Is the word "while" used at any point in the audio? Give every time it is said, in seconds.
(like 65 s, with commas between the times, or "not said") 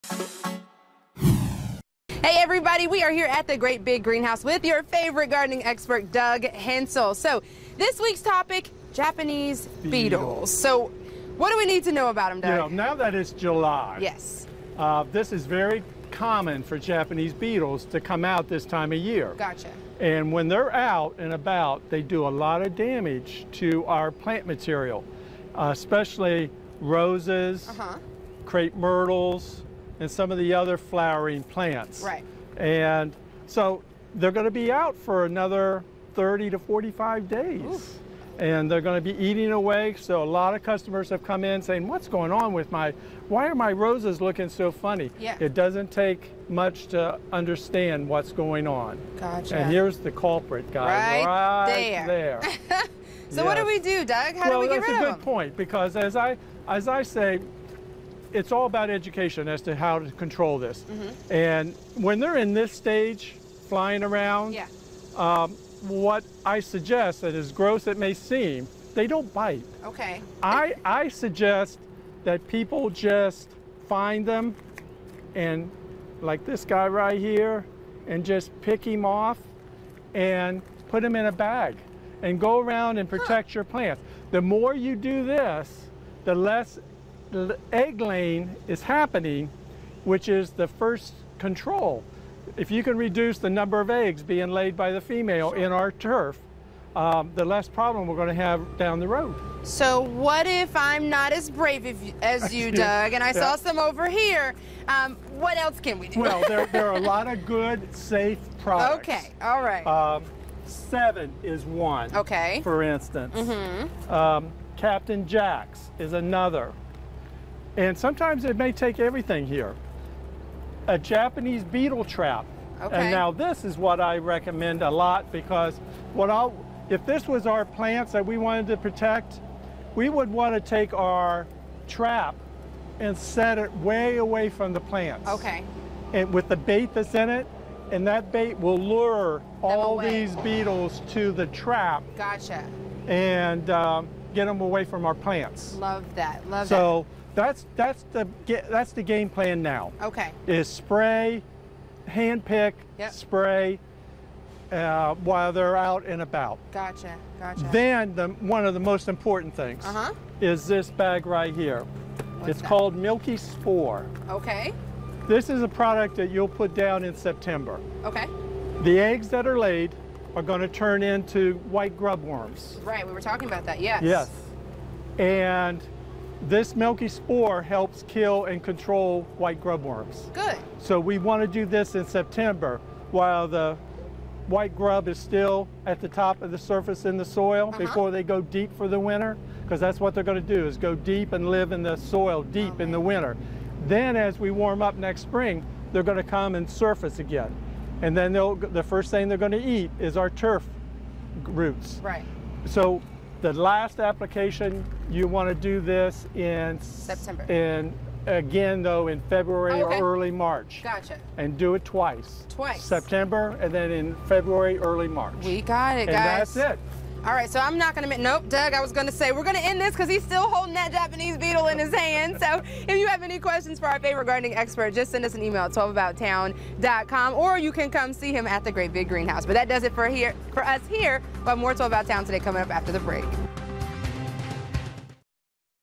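155 s, 183 s.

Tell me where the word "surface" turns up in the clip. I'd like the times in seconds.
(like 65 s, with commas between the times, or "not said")
186 s, 196 s.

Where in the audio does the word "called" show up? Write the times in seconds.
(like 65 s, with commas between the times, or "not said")
162 s.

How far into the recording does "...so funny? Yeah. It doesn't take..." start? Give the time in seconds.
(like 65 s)
44 s.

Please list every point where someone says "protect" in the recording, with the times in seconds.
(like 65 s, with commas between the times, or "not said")
83 s, 128 s.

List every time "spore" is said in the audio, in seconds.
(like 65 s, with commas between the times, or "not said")
163 s, 177 s.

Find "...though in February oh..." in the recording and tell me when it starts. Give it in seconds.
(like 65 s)
208 s.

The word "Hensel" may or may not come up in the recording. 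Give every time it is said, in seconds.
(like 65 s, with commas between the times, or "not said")
6 s.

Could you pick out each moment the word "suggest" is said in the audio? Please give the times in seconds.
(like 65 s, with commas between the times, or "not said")
66 s, 71 s.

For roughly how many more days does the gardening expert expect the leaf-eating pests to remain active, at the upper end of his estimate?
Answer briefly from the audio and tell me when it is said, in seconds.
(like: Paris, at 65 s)
45 days, at 36 s.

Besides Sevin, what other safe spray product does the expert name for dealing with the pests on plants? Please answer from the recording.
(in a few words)
Captain Jack's.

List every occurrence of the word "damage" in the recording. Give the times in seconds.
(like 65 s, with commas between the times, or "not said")
22 s.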